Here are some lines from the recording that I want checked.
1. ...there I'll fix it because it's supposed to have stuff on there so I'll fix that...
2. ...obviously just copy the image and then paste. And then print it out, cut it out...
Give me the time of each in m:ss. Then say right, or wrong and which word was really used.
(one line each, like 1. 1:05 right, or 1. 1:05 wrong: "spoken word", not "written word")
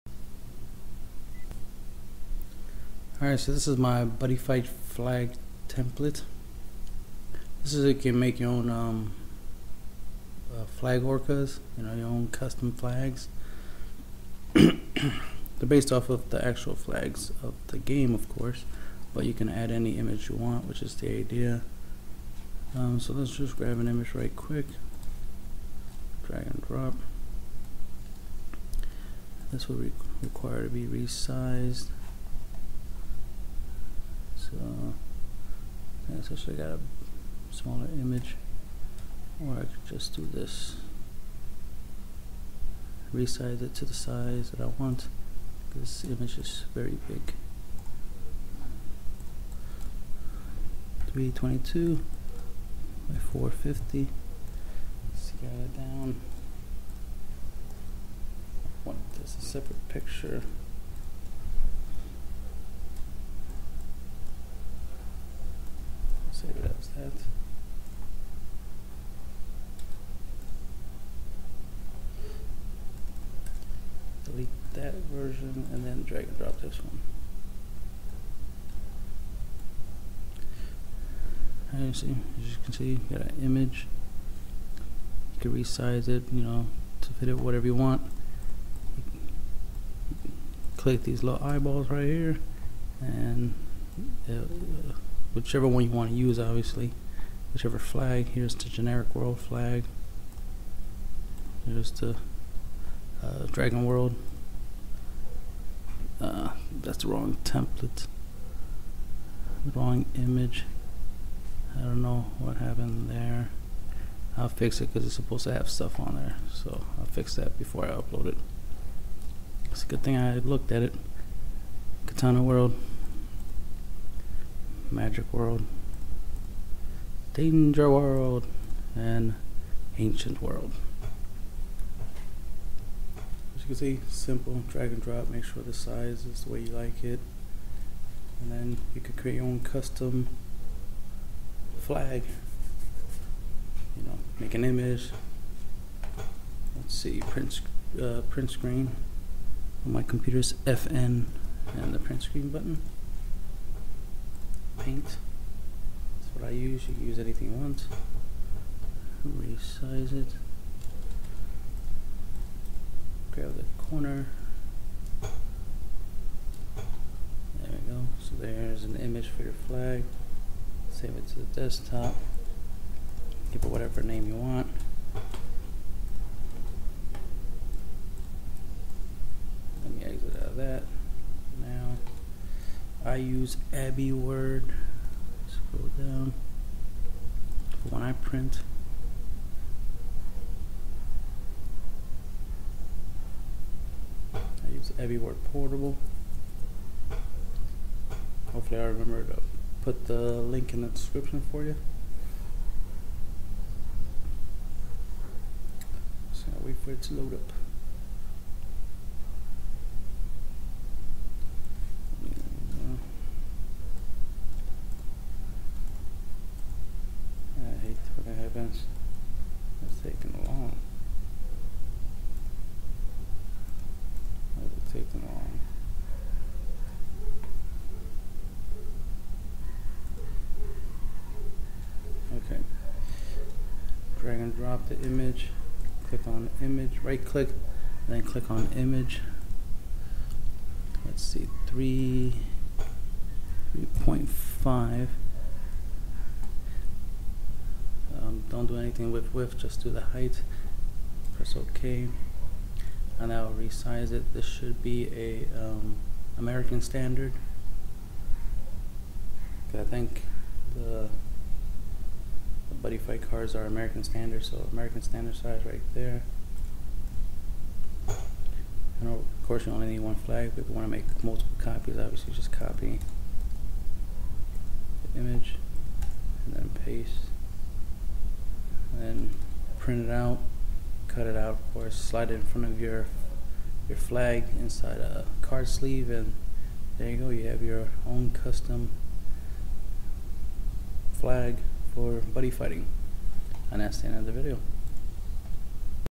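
1. 1:53 right
2. 4:31 right.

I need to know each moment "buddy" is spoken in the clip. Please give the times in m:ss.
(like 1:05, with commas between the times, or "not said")
0:04, 4:22, 4:52.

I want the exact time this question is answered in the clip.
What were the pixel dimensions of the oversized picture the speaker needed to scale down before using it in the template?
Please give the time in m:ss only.
0:51.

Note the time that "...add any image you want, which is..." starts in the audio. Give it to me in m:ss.
0:19.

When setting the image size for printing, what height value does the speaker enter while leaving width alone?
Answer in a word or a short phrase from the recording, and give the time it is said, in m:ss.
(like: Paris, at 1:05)
3.5, at 4:03.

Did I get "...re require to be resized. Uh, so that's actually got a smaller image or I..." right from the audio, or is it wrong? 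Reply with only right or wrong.
right.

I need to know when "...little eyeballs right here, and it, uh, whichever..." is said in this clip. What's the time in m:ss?
1:31.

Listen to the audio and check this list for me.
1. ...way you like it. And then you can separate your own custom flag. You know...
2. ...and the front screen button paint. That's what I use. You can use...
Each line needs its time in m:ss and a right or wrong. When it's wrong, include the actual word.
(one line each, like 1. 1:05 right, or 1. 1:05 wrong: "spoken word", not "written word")
1. 2:16 wrong: "create", not "separate"
2. 2:31 wrong: "print", not "front".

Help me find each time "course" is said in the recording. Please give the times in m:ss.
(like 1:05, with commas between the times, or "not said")
0:18, 4:29, 4:41.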